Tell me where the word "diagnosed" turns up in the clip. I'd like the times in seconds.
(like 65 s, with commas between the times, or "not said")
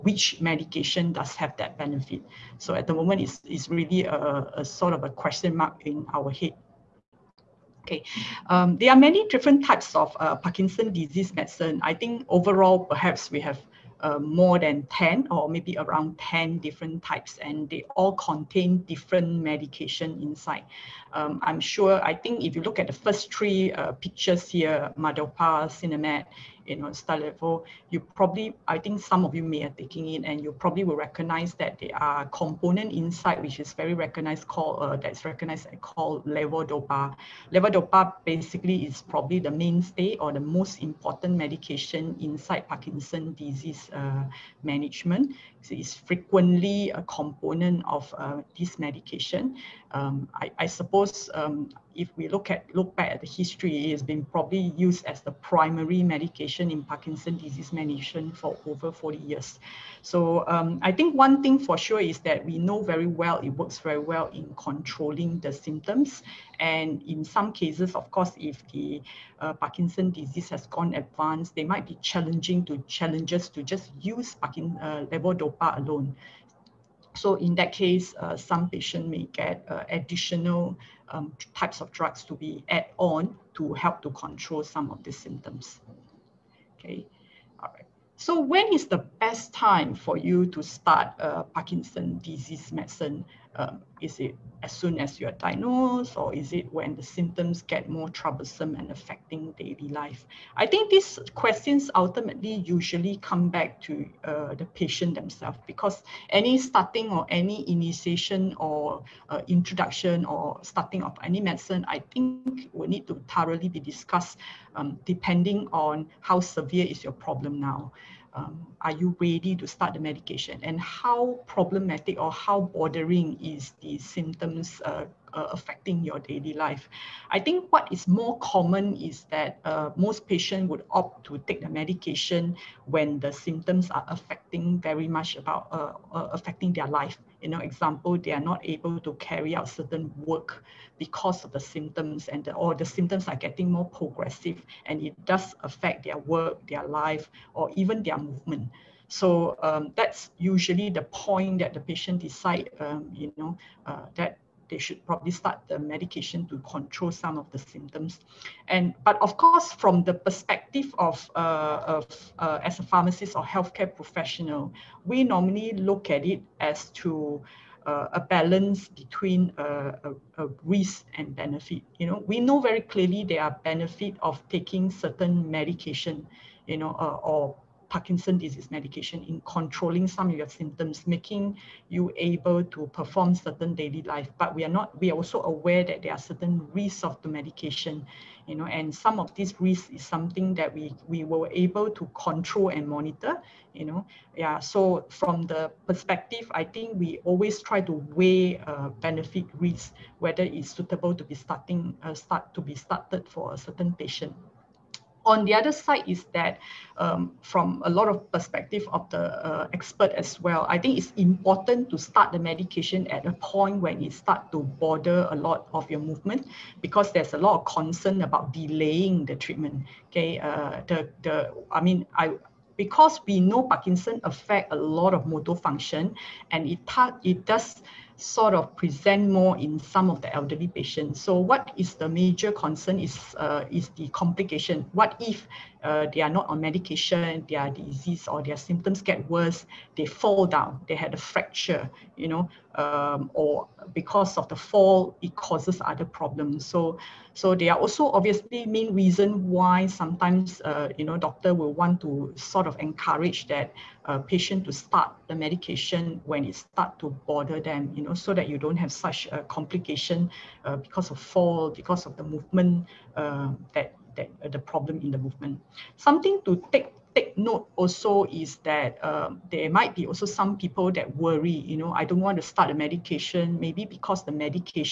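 95 s.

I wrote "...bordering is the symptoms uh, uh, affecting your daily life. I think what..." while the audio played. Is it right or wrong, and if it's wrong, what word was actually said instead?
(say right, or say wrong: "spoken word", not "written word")
right.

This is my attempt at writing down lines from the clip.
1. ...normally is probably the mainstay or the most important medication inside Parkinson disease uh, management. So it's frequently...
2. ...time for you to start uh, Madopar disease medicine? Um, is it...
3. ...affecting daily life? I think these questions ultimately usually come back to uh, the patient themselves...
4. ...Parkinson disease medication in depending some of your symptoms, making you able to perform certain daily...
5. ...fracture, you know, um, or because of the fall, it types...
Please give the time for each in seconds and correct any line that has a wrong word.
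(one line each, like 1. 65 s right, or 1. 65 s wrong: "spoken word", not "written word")
1. 38 s wrong: "basically", not "normally"
2. 89 s wrong: "Parkinson", not "Madopar"
3. 98 s right
4. 177 s wrong: "controlling", not "depending"
5. 241 s wrong: "causes", not "types".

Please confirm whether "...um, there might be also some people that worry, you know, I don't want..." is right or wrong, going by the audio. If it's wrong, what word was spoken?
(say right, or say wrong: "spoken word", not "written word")
right.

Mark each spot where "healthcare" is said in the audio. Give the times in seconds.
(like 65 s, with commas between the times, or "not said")
163 s.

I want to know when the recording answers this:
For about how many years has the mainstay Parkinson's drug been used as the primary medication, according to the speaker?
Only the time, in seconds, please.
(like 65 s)
58 s.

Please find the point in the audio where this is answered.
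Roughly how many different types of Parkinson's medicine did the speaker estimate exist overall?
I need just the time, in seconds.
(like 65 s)
15 s.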